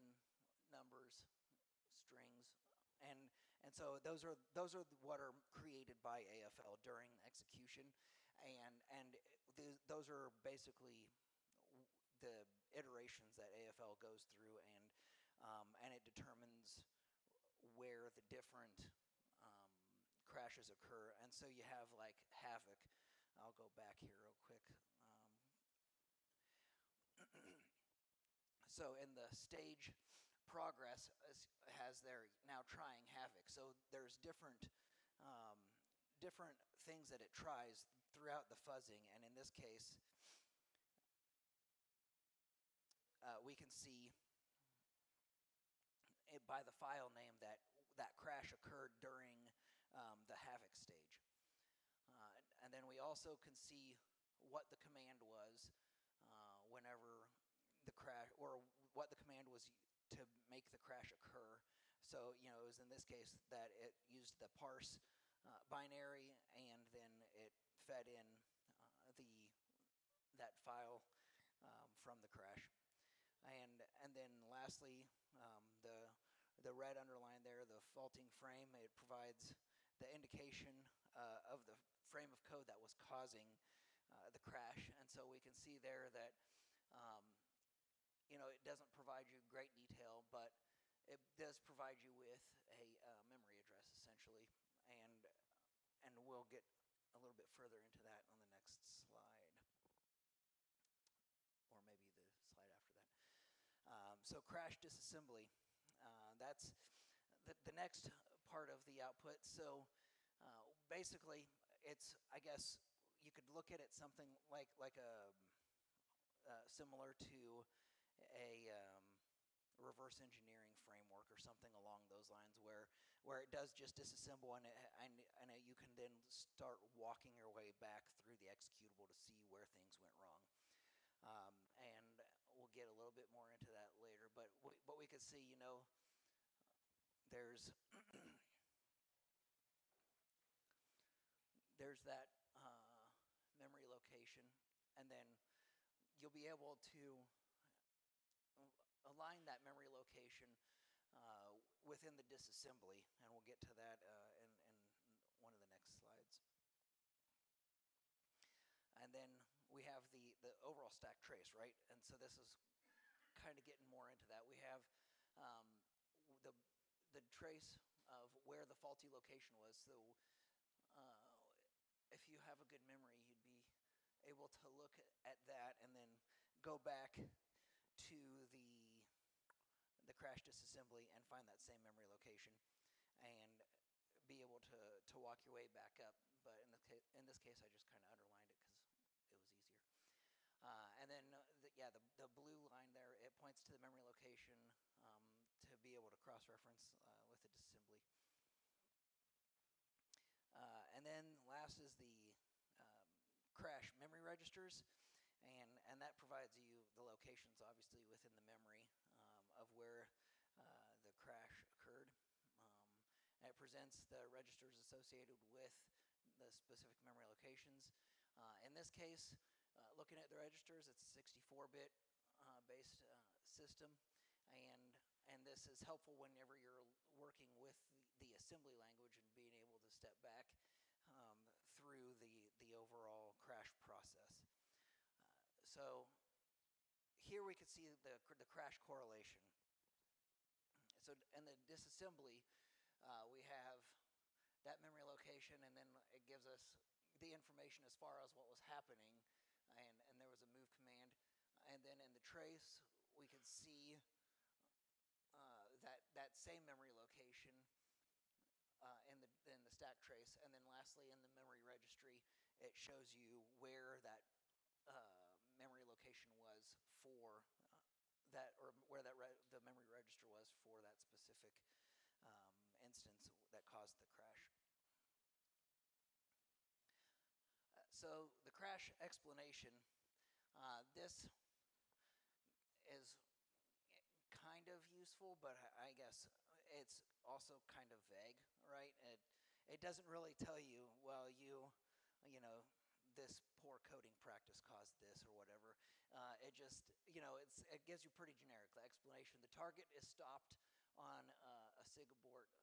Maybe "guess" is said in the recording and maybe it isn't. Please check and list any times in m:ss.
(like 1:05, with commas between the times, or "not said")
1:52, 4:45.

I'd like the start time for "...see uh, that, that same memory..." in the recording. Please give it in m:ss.
4:13.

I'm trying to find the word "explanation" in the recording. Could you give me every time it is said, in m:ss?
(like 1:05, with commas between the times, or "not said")
4:38, 4:58.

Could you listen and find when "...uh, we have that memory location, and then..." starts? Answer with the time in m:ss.
4:03.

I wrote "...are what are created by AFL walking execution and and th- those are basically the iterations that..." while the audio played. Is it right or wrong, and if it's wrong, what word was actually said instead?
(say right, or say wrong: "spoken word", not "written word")
wrong: "during", not "walking".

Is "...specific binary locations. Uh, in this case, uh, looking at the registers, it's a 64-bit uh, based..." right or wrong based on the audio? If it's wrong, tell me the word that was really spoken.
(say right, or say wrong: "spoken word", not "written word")
wrong: "memory", not "binary".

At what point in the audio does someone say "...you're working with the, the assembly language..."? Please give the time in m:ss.
3:46.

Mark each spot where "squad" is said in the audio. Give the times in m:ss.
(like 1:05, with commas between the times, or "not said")
not said.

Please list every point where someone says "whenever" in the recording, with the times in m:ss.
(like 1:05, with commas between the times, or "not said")
0:56, 3:46.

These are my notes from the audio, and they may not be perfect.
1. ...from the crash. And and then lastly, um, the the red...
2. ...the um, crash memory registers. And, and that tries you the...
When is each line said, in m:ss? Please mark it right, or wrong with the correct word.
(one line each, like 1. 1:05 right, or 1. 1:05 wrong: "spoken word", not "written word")
1. 1:12 right
2. 3:22 wrong: "provides", not "tries".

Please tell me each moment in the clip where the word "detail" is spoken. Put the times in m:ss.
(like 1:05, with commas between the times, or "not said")
1:29.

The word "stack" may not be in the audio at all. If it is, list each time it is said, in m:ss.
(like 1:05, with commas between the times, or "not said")
2:40, 4:19.